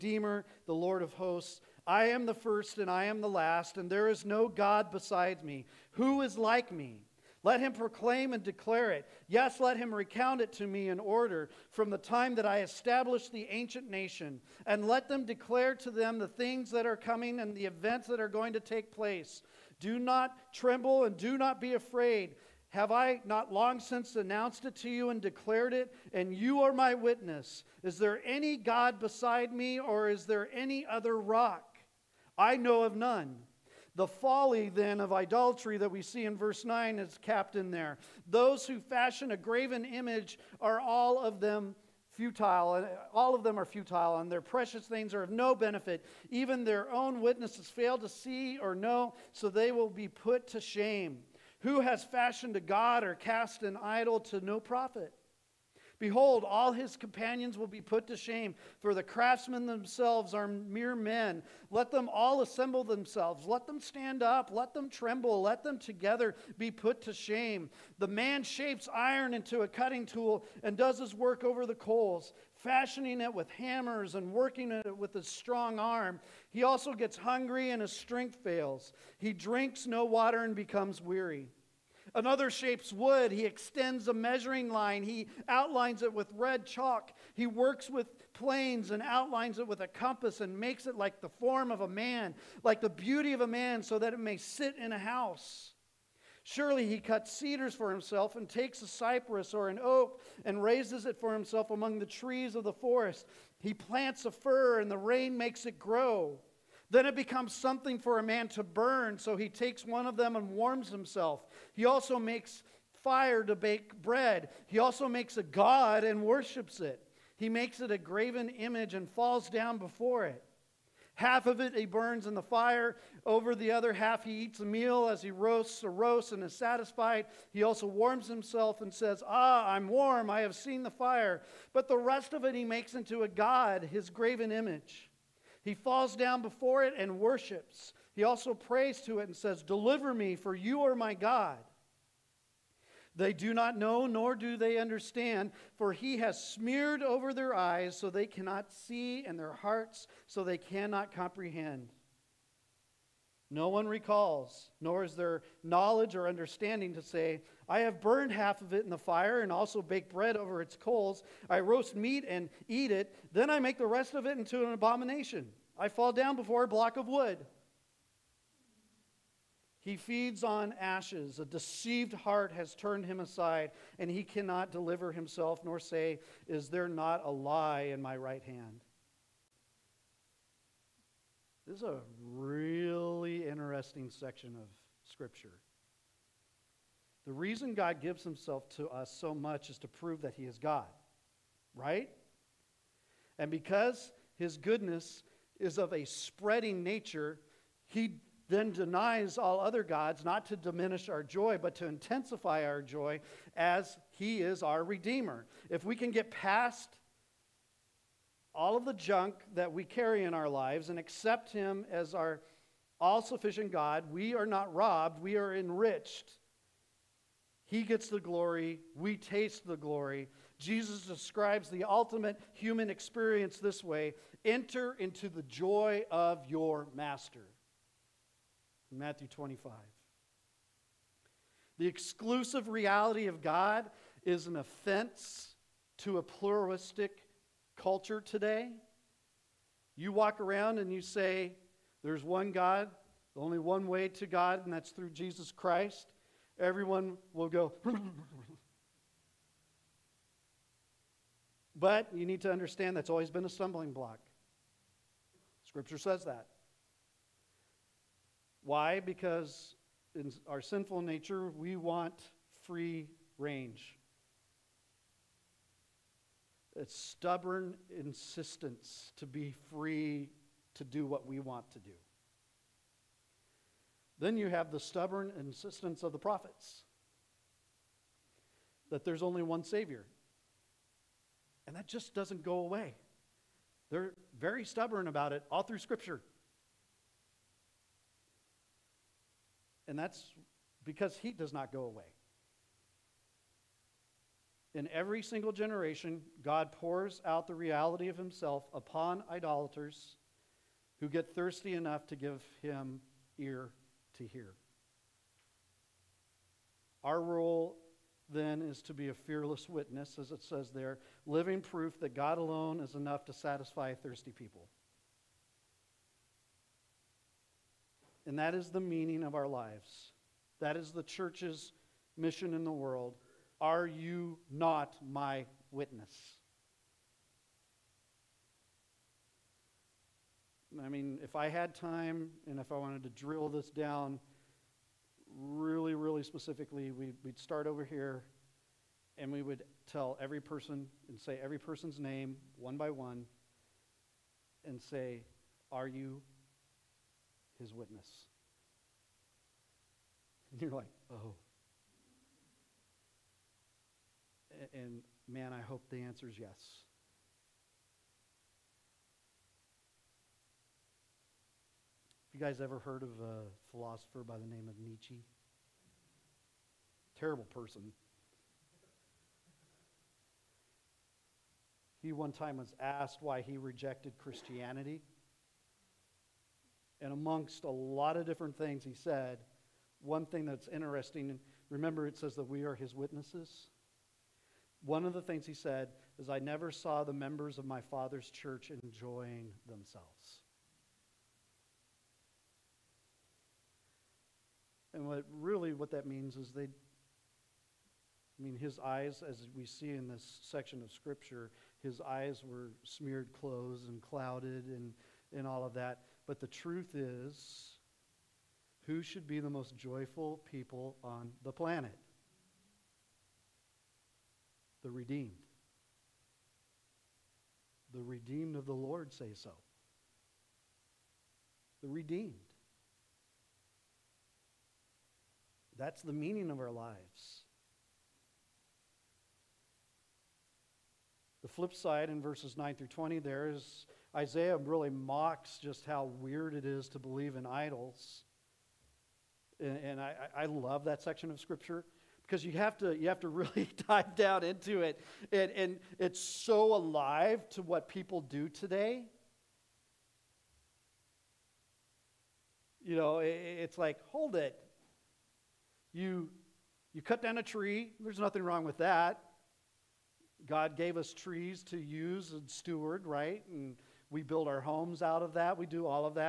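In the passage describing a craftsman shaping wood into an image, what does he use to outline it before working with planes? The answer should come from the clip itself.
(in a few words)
red chalk.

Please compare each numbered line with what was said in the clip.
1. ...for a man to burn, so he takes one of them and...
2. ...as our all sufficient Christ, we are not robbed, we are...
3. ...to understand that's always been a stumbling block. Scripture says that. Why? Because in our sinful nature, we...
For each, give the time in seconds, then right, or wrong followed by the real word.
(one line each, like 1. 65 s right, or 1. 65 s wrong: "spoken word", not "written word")
1. 107 s right
2. 211 s wrong: "God", not "Christ"
3. 252 s right.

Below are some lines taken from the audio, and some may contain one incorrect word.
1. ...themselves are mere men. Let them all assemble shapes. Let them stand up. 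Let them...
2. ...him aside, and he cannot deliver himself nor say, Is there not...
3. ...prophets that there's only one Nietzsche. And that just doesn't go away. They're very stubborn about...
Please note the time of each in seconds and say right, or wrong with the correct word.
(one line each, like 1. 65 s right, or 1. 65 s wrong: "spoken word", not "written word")
1. 59 s wrong: "themselves", not "shapes"
2. 173 s right
3. 276 s wrong: "Savior", not "Nietzsche".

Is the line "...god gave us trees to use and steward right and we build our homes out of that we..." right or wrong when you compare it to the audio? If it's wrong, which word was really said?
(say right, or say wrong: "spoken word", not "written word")
right.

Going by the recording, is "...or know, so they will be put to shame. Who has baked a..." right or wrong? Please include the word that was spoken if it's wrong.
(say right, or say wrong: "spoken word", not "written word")
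wrong: "fashioned", not "baked".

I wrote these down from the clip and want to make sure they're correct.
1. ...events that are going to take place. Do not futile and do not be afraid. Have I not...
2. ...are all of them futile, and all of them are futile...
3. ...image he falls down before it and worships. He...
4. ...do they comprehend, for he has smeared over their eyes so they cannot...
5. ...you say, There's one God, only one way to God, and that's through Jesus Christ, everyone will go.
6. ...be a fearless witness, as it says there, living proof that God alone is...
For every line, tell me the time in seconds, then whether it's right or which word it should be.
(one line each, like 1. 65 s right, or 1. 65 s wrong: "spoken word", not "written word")
1. 17 s wrong: "tremble", not "futile"
2. 40 s right
3. 134 s right
4. 144 s wrong: "understand", not "comprehend"
5. 240 s right
6. 308 s right.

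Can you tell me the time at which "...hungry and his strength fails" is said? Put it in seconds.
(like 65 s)
77 s.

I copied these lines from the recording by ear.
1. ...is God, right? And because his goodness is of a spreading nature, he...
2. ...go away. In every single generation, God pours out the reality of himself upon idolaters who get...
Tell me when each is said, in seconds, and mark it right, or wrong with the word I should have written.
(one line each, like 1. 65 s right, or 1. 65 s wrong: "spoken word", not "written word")
1. 190 s right
2. 291 s right.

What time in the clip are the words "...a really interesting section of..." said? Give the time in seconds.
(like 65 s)
181 s.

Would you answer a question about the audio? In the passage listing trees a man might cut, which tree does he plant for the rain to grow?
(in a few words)
fir.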